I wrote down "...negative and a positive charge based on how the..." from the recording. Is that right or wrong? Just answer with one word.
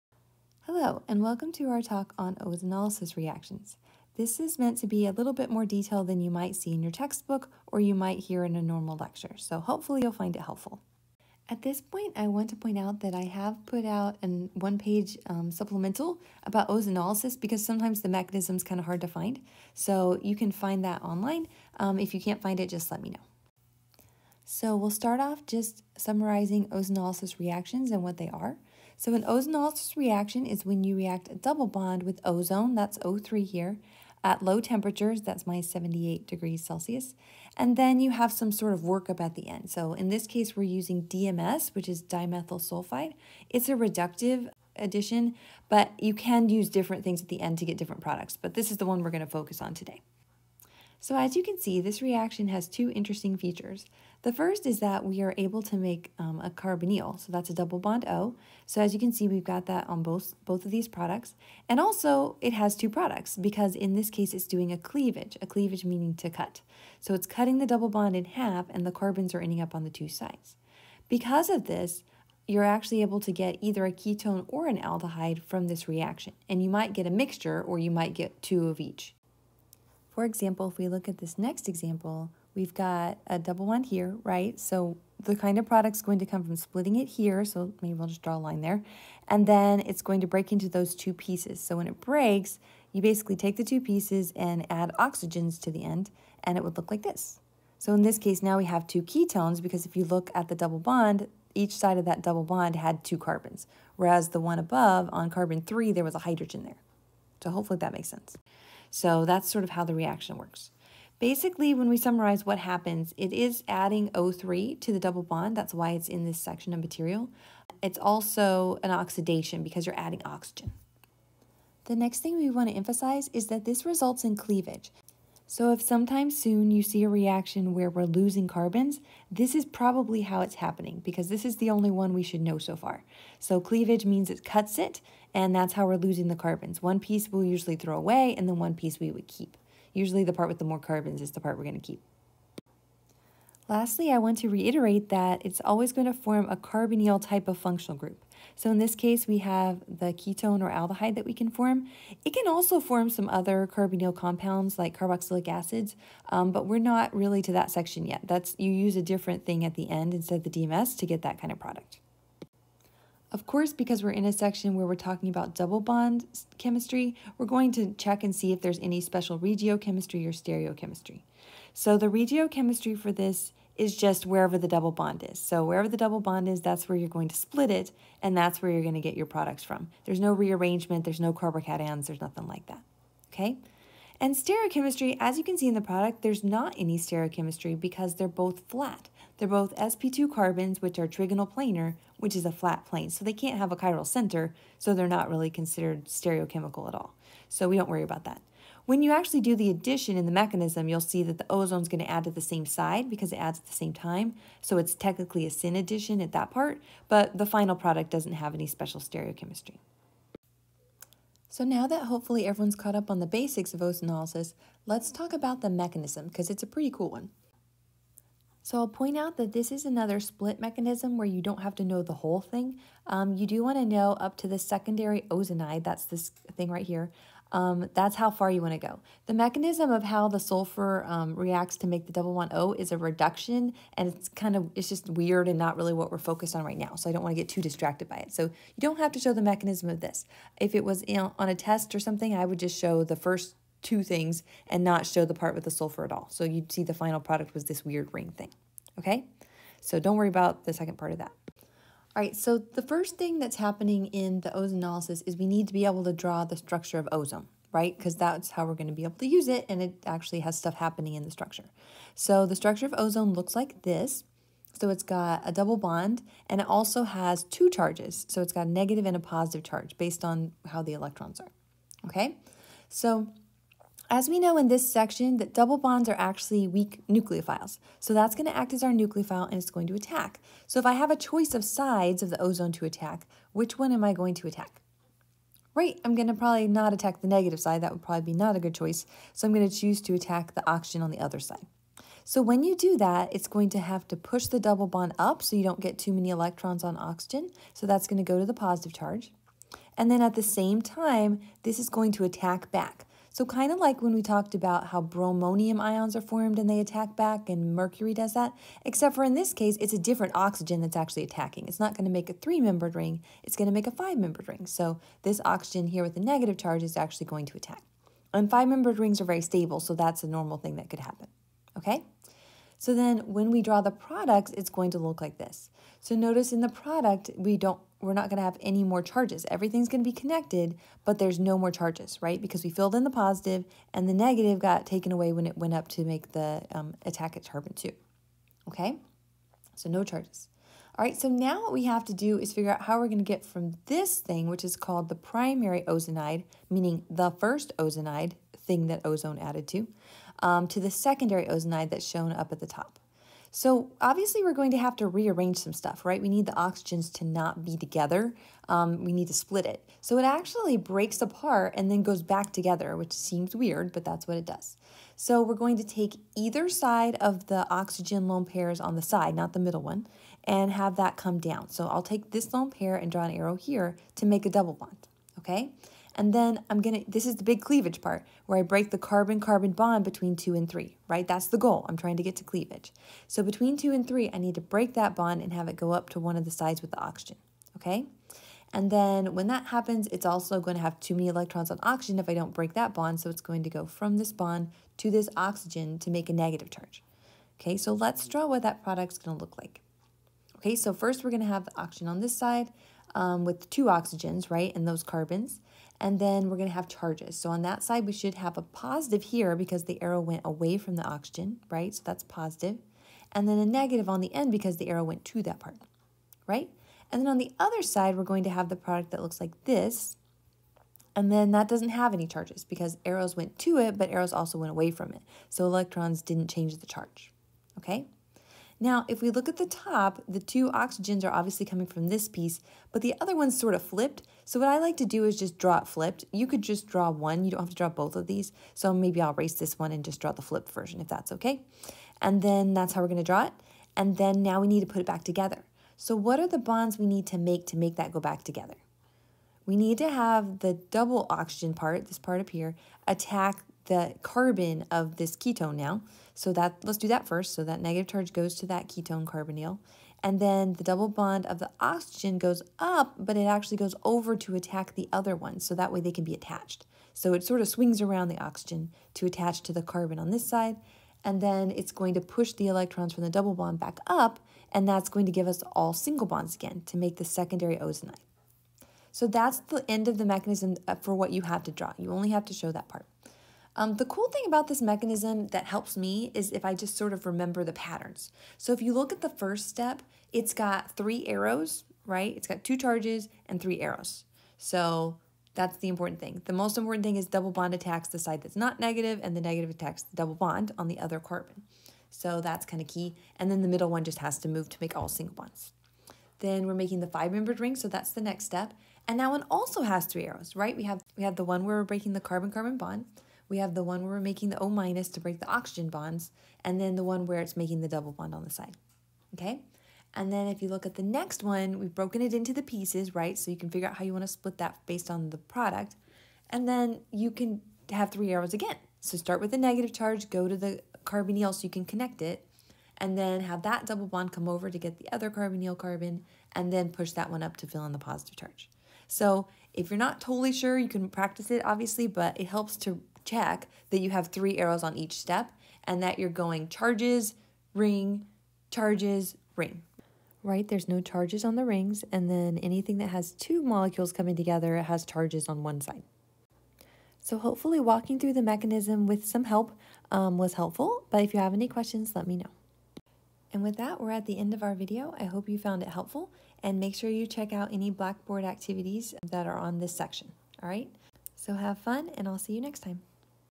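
right.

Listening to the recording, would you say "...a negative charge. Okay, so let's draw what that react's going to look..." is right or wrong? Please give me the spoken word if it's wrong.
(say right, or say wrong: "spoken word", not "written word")
wrong: "product", not "react".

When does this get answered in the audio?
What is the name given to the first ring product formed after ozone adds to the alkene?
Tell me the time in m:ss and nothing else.
5:45.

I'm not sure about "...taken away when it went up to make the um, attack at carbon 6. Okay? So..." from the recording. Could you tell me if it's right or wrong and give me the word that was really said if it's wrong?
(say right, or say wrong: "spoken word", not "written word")
wrong: "2", not "6".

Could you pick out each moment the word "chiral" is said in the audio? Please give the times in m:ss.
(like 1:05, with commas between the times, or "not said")
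3:13.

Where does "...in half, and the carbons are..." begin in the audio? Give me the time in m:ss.
1:08.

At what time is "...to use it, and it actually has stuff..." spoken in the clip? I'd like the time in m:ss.
4:19.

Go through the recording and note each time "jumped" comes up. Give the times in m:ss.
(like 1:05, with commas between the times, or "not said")
not said.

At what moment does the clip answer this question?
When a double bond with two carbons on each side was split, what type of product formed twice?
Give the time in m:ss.
1:38.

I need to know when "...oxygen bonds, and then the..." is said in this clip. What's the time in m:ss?
8:35.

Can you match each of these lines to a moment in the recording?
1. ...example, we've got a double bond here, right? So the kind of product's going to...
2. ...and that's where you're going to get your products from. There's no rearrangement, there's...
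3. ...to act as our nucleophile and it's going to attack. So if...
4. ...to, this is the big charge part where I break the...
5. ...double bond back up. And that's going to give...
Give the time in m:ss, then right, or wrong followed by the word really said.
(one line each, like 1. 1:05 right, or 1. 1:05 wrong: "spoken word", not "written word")
1. 1:21 right
2. 2:58 right
3. 4:38 right
4. 6:17 wrong: "cleavage", not "charge"
5. 7:53 right.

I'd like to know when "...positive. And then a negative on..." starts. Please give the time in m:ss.
6:52.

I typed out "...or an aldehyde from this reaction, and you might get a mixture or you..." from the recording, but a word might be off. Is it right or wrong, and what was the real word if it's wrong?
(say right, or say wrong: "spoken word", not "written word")
right.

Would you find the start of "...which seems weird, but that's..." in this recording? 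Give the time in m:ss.
6:02.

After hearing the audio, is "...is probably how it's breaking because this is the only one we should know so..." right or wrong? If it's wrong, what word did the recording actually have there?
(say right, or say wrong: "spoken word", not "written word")
wrong: "happening", not "breaking".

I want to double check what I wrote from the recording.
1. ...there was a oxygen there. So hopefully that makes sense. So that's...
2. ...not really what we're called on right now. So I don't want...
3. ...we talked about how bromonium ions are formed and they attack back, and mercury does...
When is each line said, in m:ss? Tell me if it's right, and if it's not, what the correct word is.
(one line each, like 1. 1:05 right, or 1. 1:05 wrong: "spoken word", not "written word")
1. 1:45 wrong: "hydrogen", not "oxygen"
2. 3:55 wrong: "focused", not "called"
3. 5:04 right.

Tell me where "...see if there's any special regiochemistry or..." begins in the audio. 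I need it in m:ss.
2:48.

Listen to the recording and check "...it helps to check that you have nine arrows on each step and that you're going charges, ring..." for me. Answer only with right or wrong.
wrong.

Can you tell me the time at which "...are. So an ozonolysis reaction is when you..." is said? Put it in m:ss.
0:28.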